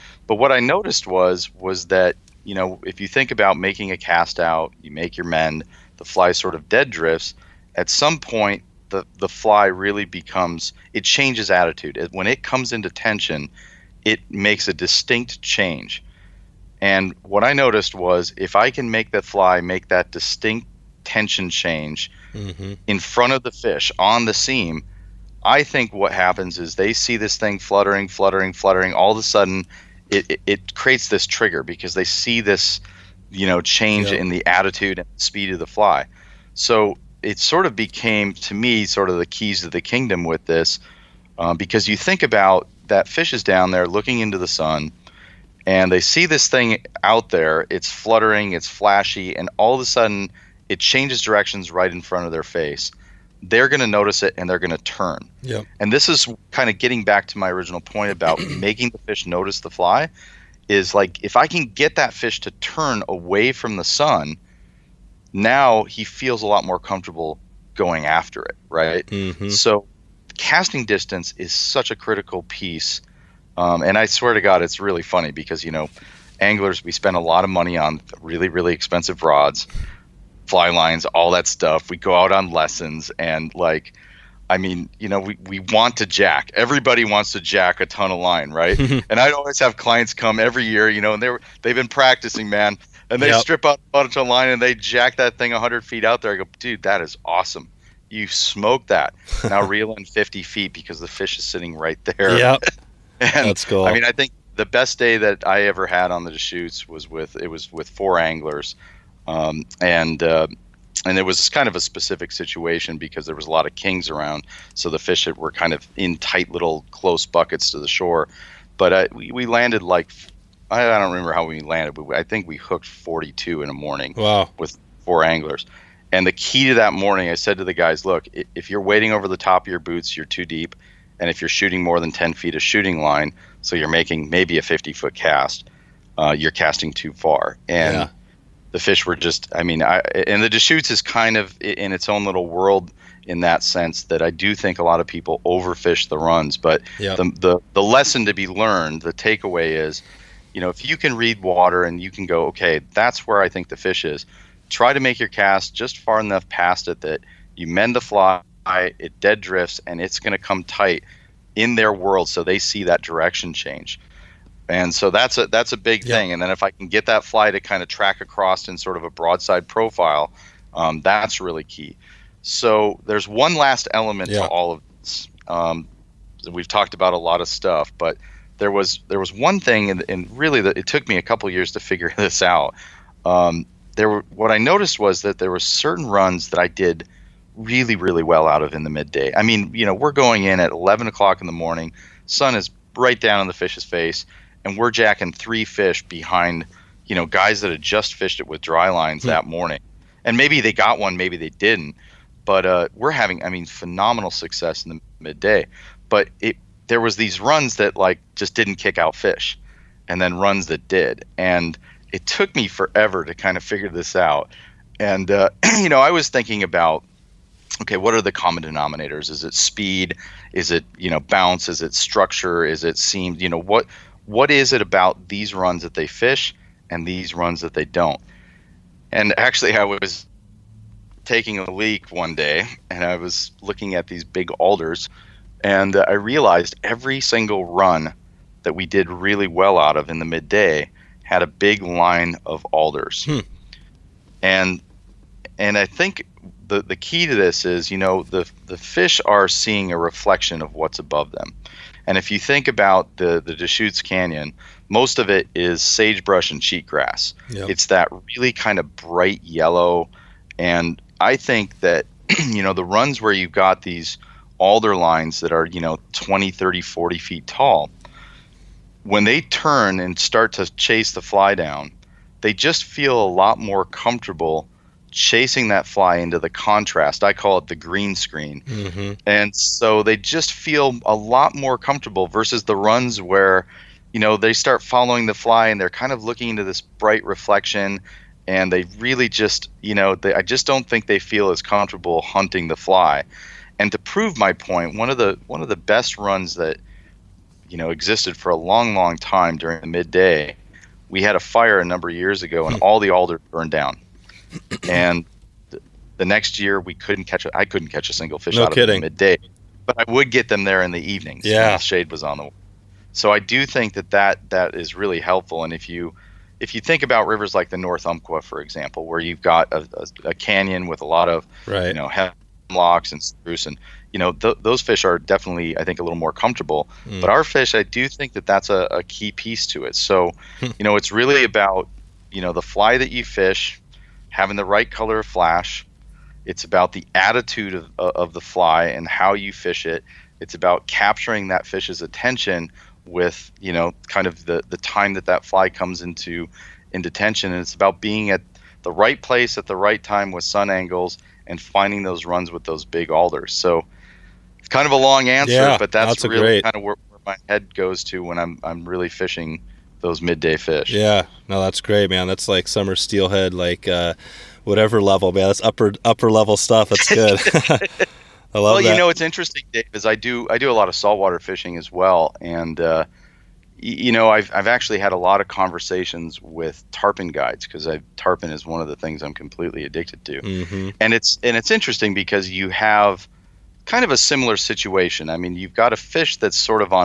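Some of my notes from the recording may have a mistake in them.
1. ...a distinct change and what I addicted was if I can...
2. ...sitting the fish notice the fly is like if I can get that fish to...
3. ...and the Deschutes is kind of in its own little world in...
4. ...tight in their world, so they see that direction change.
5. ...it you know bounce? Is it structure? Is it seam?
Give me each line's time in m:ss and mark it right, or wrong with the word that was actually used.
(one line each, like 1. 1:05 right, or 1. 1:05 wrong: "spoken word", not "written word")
1. 0:14 wrong: "noticed", not "addicted"
2. 0:58 wrong: "making", not "sitting"
3. 2:20 right
4. 2:40 right
5. 3:40 right.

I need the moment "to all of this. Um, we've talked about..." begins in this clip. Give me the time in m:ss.
2:54.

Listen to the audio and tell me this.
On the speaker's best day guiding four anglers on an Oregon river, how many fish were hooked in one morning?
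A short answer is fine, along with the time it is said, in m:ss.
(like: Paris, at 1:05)
42, at 2:02.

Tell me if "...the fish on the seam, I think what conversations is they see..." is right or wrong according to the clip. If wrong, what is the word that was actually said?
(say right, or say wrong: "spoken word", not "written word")
wrong: "happens", not "conversations".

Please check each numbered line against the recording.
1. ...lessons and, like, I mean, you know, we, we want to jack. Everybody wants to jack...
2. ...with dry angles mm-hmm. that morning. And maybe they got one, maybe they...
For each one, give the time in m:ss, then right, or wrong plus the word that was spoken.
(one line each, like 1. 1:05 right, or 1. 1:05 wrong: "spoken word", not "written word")
1. 1:22 right
2. 3:18 wrong: "lines", not "angles".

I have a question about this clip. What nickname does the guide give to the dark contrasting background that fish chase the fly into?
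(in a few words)
the green screen.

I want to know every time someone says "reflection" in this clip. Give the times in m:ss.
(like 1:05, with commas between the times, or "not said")
4:09, 4:47.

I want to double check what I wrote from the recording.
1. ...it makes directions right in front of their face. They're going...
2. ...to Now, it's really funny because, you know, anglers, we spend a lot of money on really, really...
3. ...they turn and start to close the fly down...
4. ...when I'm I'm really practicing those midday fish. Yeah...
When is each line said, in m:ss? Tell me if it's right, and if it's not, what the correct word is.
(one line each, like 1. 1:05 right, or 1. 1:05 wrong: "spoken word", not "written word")
1. 0:50 wrong: "changes", not "makes"
2. 1:14 wrong: "God", not "Now"
3. 4:29 wrong: "chase", not "close"
4. 5:58 wrong: "fishing", not "practicing".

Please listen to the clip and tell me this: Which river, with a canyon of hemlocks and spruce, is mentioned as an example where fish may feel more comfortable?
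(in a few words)
North Umpqua.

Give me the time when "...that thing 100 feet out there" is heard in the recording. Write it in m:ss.
1:35.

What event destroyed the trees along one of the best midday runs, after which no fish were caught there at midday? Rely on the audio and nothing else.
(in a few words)
a fire.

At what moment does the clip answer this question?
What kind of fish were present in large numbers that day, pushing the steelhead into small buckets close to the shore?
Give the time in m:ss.
1:53.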